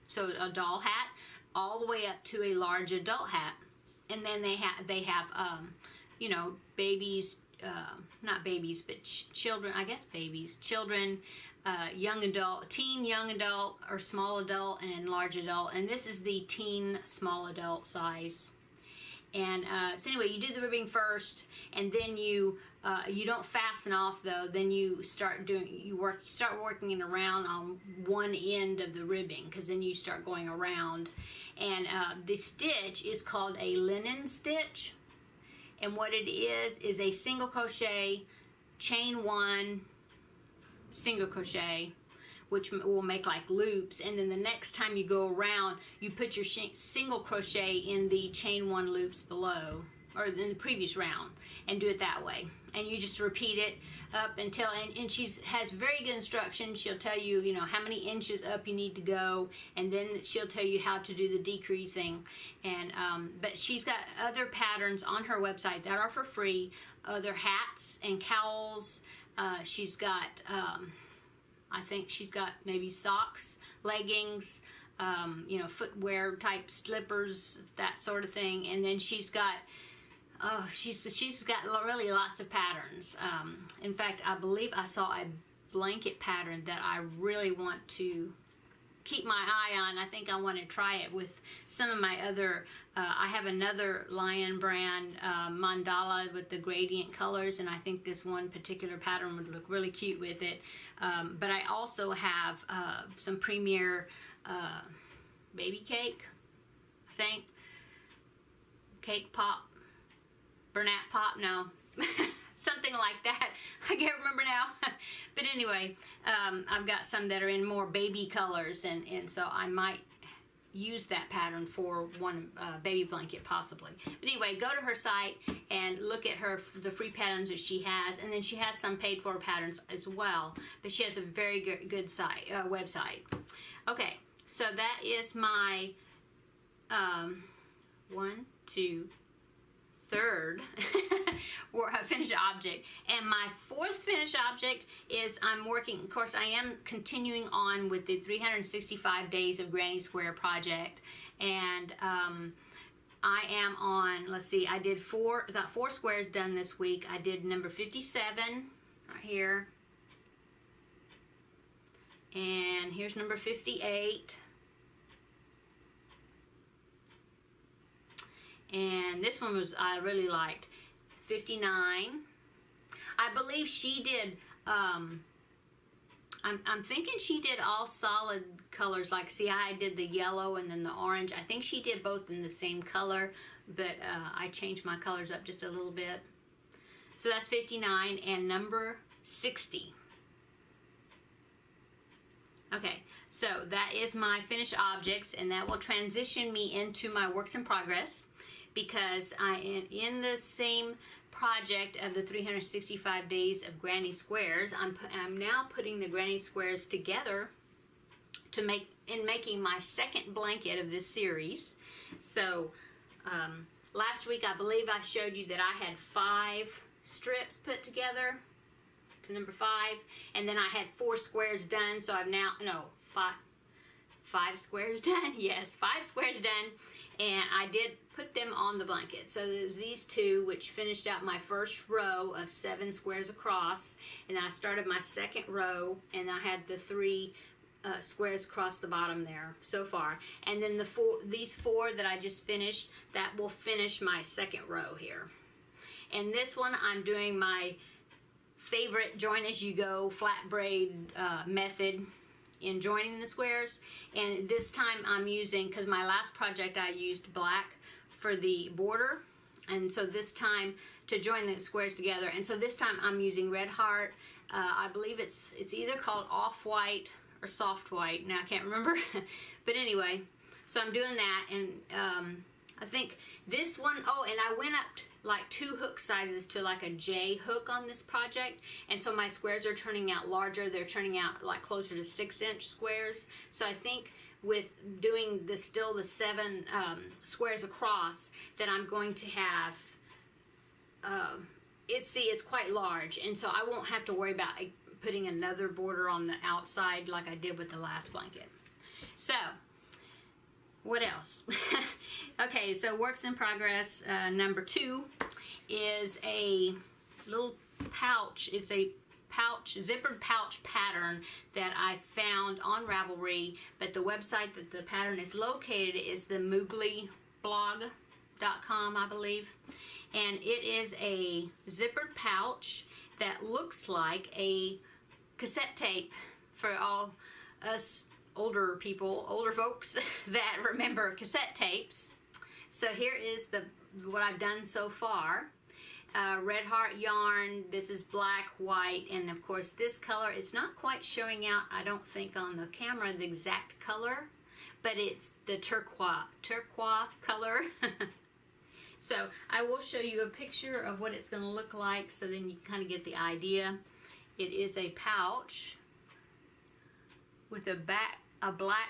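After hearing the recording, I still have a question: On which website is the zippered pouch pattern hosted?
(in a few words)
Mooglyblog.com.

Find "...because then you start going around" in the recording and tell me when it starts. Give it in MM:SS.
00:29.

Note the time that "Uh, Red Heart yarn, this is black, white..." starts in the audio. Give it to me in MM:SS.
05:36.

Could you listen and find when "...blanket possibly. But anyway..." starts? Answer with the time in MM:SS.
02:03.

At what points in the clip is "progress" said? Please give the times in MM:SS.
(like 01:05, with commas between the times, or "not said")
03:17, 05:03.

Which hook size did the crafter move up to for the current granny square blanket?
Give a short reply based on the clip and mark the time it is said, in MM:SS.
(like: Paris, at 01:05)
J, at 04:36.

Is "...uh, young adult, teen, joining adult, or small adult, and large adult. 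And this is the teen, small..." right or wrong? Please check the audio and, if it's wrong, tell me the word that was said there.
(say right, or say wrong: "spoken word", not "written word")
wrong: "young", not "joining".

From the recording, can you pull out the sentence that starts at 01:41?
Um, but I also have uh, some Premier uh, Baby Cake, I think.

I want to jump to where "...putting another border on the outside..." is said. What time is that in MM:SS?
04:55.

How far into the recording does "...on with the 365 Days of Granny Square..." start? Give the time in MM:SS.
02:27.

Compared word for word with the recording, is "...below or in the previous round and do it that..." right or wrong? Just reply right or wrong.
right.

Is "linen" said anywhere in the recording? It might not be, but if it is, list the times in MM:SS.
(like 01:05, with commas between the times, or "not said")
00:33.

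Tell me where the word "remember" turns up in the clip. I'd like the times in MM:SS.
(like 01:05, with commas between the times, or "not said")
01:54, 04:28, 05:30.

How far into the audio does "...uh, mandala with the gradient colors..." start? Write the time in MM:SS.
01:35.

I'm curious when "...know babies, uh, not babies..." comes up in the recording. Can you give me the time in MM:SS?
00:06.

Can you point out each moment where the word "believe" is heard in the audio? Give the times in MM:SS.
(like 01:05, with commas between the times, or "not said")
01:24, 02:53, 03:34, 04:24, 05:19.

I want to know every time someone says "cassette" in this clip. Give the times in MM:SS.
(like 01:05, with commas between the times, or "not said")
05:25, 05:31.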